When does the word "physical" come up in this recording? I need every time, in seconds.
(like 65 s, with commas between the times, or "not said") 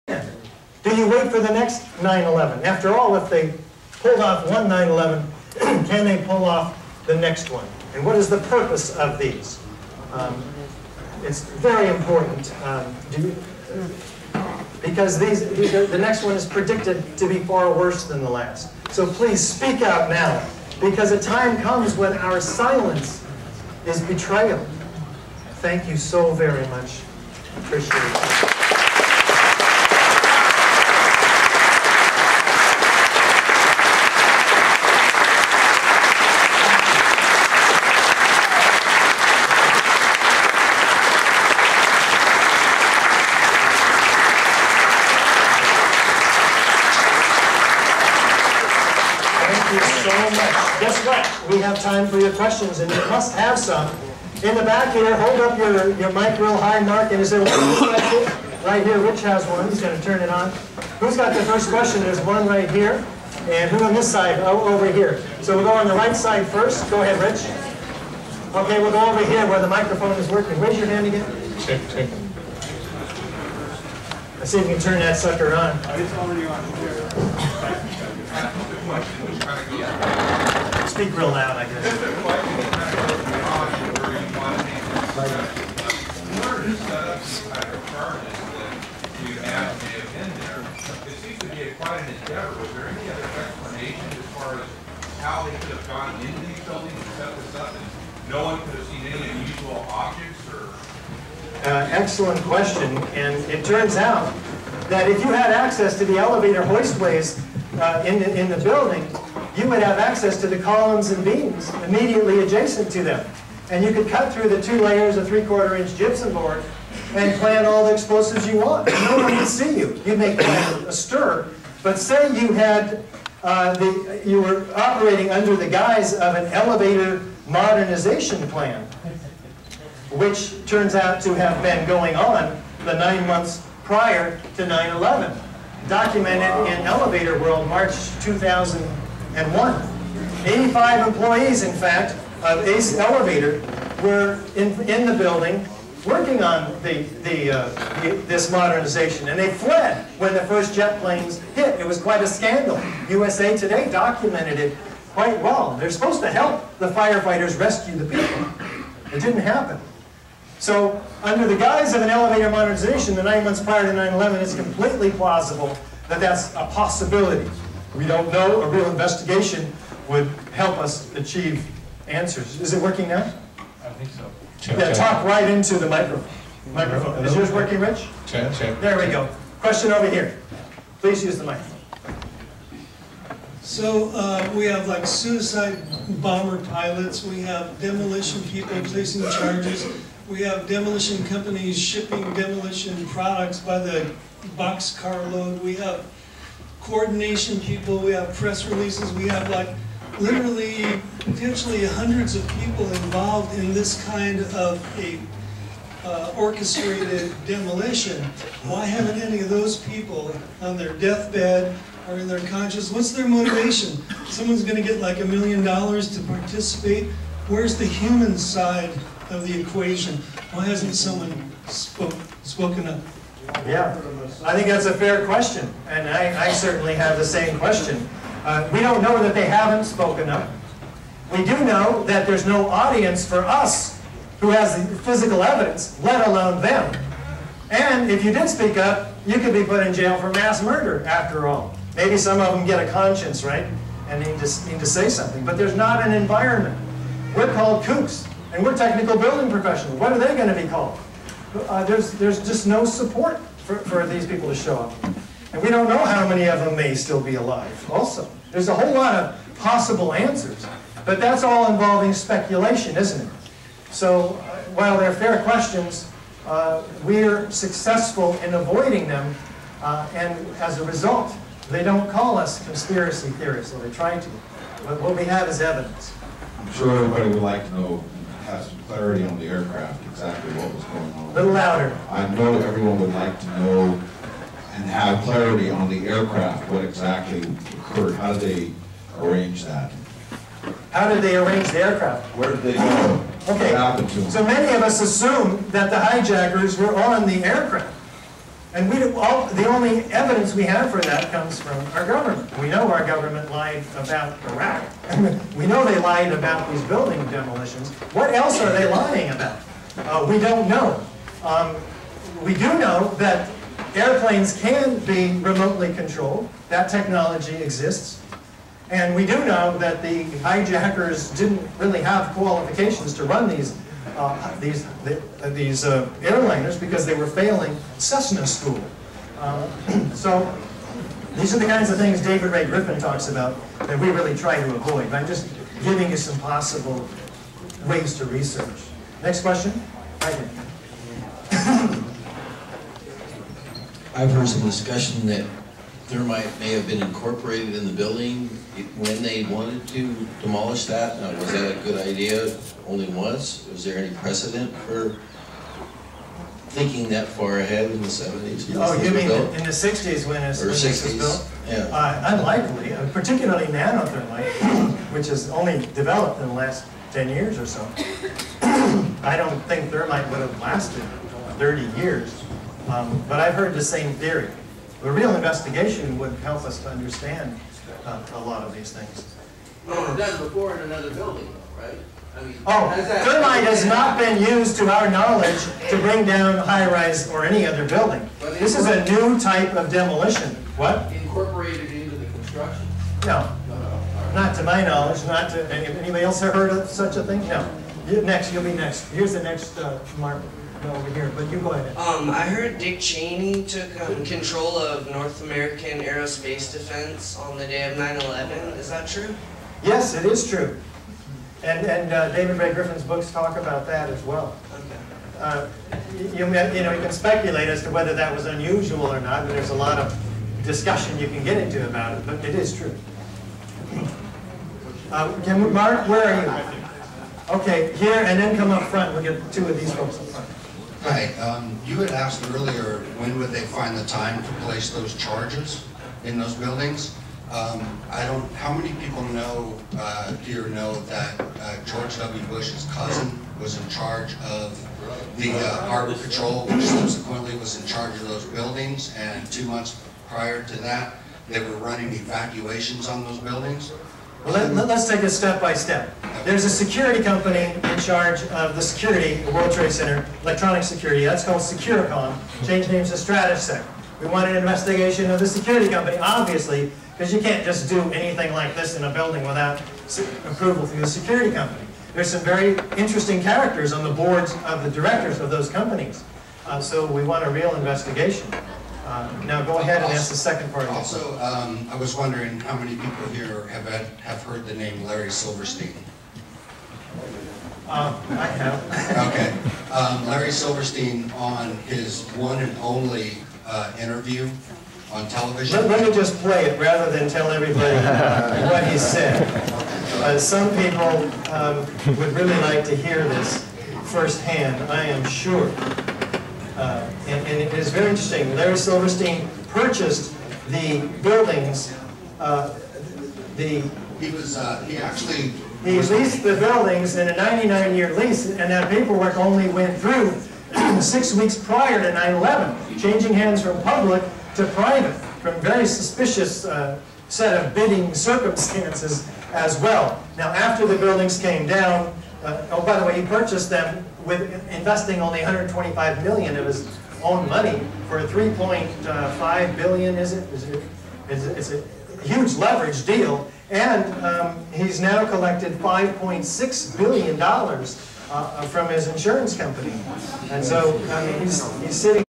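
234 s.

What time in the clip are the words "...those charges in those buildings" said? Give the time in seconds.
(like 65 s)
434 s.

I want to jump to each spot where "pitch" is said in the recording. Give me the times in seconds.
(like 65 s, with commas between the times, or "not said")
not said.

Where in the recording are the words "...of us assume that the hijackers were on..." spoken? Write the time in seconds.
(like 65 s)
294 s.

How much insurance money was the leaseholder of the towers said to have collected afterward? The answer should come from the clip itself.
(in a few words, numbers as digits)
$5.6 billion.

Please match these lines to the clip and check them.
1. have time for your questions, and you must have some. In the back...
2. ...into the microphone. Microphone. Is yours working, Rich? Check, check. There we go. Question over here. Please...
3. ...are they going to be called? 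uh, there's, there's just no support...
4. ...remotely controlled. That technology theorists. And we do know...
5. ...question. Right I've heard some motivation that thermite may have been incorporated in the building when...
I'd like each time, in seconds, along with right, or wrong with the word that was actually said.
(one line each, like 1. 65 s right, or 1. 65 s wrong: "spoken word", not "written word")
1. 51 s right
2. 175 s right
3. 250 s right
4. 315 s wrong: "exists", not "theorists"
5. 339 s wrong: "discussion", not "motivation".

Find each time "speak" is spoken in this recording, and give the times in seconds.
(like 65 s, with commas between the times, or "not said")
19 s, 80 s, 238 s.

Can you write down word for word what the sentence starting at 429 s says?
We'll get two of these folks up front.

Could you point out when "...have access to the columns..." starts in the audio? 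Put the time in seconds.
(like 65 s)
109 s.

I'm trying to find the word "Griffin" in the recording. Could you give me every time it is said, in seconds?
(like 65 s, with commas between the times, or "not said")
332 s, 412 s.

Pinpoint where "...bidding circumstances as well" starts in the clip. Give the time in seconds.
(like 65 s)
527 s.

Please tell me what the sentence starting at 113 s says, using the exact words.
And you could cut through the two layers of three-quarter inch gypsum board and plant all the explosives you want.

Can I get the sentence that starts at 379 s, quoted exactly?
Well, it was done before in another building, though, right?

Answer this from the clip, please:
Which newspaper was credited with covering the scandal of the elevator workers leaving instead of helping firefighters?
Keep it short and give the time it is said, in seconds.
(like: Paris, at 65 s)
USA Today, at 153 s.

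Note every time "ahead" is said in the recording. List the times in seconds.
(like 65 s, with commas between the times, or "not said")
67 s, 357 s, 401 s, 479 s.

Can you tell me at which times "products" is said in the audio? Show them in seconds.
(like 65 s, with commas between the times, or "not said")
193 s.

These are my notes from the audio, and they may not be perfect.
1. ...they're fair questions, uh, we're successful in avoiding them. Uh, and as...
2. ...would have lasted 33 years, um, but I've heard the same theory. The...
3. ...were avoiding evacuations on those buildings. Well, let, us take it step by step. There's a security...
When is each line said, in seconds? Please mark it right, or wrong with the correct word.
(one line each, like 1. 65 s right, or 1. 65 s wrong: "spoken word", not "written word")
1. 264 s right
2. 370 s wrong: "30", not "33"
3. 451 s wrong: "running", not "avoiding".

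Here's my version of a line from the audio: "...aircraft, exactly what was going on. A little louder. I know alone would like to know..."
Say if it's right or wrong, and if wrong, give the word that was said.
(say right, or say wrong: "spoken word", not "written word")
wrong: "everyone", not "alone".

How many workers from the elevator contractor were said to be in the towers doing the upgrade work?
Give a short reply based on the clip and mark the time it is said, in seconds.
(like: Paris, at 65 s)
85, at 140 s.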